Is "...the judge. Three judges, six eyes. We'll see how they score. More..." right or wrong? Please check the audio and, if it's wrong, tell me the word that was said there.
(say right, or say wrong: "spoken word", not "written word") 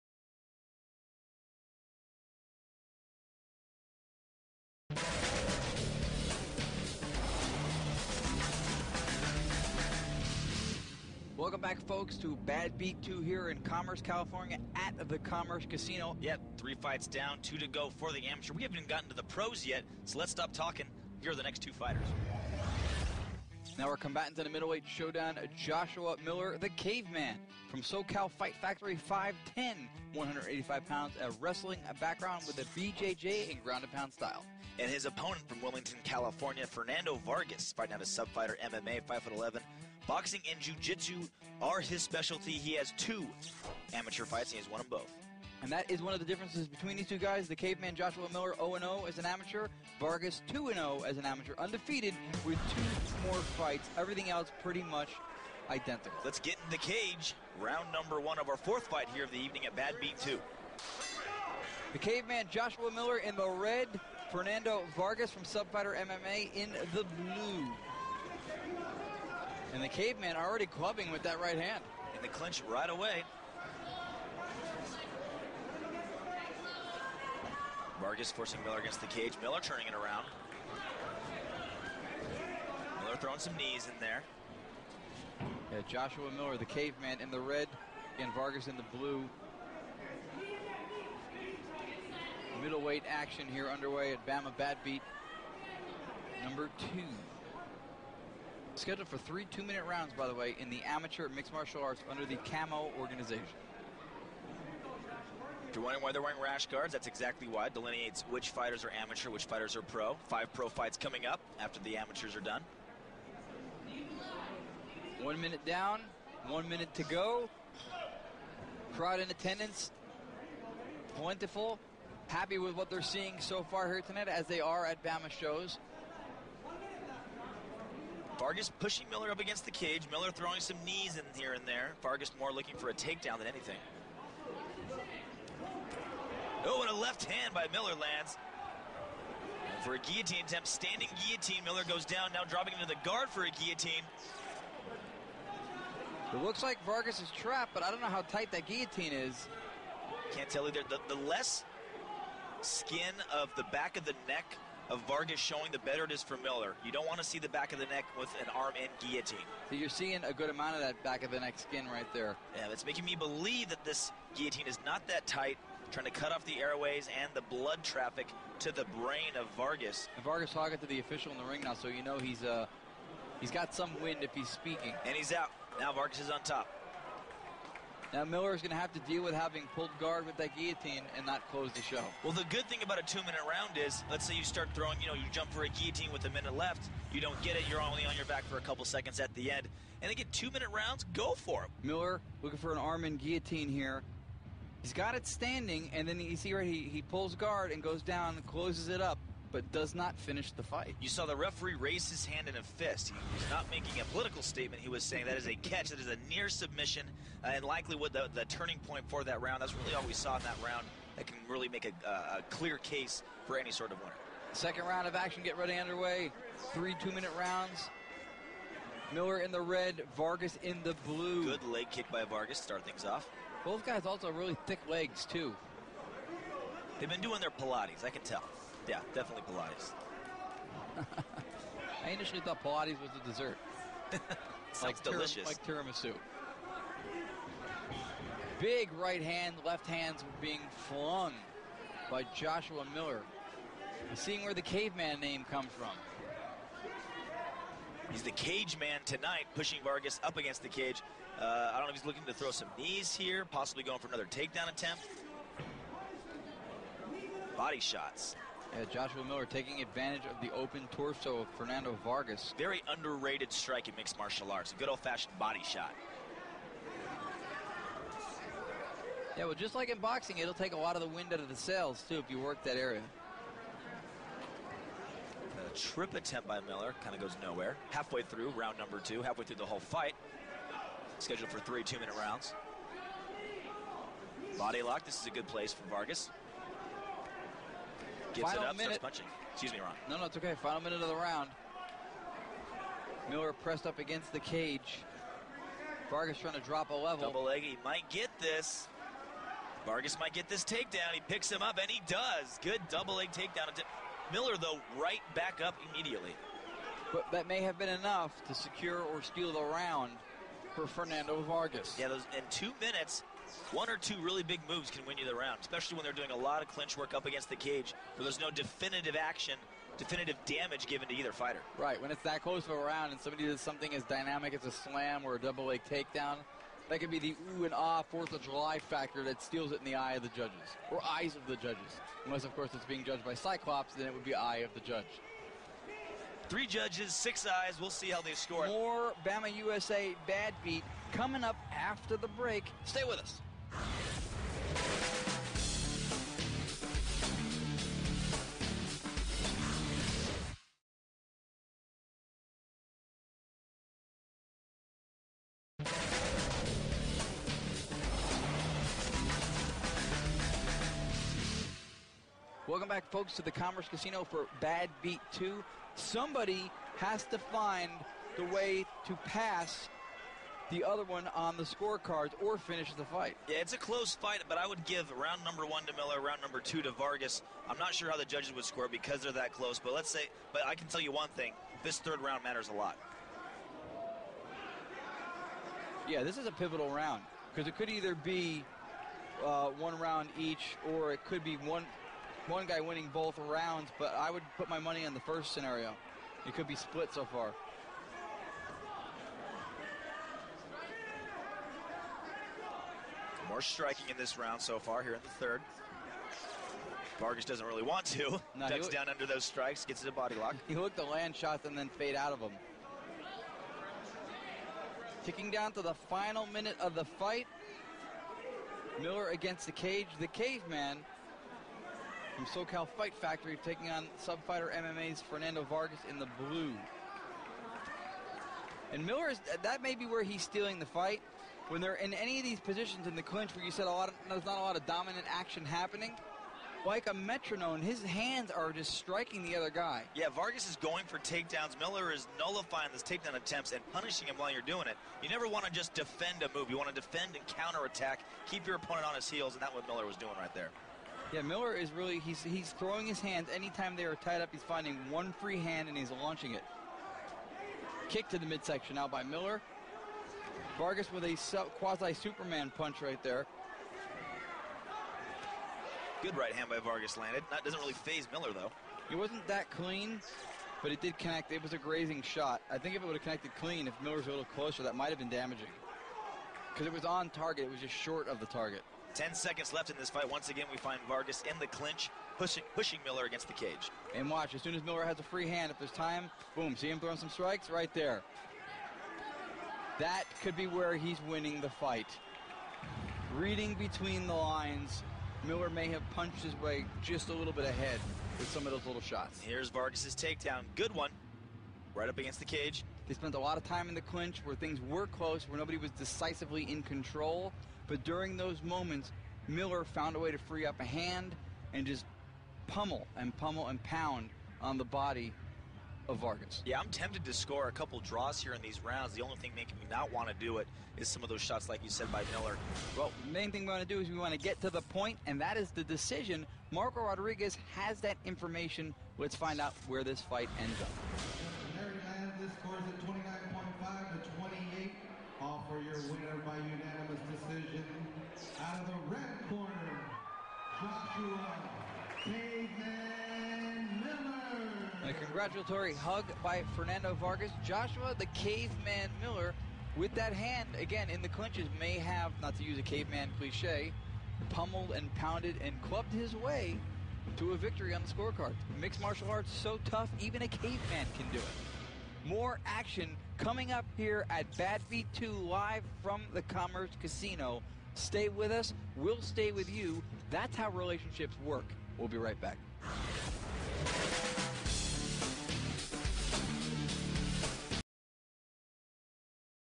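right.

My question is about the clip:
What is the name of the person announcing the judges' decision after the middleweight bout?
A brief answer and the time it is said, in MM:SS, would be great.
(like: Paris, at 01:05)
Marco Rodriguez, at 08:46.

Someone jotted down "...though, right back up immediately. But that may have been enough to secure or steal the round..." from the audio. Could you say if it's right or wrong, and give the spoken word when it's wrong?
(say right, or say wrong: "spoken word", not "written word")
right.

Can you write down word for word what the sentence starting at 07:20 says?
Yeah, Vargas is going for takedowns.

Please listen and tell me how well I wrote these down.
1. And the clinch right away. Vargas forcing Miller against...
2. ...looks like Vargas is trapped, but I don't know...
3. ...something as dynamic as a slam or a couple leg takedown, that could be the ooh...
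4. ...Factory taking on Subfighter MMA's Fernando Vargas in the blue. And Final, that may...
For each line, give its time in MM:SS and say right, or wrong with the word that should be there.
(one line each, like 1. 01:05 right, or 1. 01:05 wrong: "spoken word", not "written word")
1. 01:12 right
2. 02:26 right
3. 05:23 wrong: "double", not "couple"
4. 07:03 wrong: "Miller", not "Final".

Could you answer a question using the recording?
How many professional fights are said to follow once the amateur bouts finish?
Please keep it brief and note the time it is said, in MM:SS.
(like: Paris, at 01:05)
5, at 01:50.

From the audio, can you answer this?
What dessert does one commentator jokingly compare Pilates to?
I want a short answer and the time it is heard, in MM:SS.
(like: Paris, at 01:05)
tiramisu, at 03:55.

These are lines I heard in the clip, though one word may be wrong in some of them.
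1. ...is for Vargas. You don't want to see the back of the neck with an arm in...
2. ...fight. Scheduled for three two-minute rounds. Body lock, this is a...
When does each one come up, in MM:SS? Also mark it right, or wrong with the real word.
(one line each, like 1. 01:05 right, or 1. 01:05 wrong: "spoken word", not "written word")
1. 02:36 wrong: "Miller", not "Vargas"
2. 04:39 right.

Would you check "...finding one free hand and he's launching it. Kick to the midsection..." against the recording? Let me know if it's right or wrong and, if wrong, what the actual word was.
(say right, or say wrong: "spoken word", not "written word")
right.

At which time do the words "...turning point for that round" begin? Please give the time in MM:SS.
03:28.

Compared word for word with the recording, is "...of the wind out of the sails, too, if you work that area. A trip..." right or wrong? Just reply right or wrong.
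right.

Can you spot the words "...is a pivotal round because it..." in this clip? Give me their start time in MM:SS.
06:26.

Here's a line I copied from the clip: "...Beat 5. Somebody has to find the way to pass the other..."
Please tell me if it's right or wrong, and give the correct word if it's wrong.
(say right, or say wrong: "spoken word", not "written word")
wrong: "2", not "5".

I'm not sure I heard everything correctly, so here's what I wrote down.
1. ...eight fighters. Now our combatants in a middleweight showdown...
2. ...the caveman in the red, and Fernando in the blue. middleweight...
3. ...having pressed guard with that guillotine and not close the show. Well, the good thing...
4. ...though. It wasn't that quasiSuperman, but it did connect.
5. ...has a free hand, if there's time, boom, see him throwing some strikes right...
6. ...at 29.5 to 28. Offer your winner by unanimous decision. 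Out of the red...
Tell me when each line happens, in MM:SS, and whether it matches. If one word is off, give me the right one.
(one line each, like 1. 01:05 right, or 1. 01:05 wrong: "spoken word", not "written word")
1. 00:21 wrong: "two", not "eight"
2. 01:26 wrong: "Vargas", not "Fernando"
3. 02:59 wrong: "pulled", not "pressed"
4. 07:48 wrong: "clean", not "quasiSuperman"
5. 08:05 right
6. 08:52 right.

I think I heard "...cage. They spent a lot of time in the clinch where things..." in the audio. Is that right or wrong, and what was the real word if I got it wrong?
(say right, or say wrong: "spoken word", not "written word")
right.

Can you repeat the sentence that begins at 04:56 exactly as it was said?
Vargas trying to drop a level.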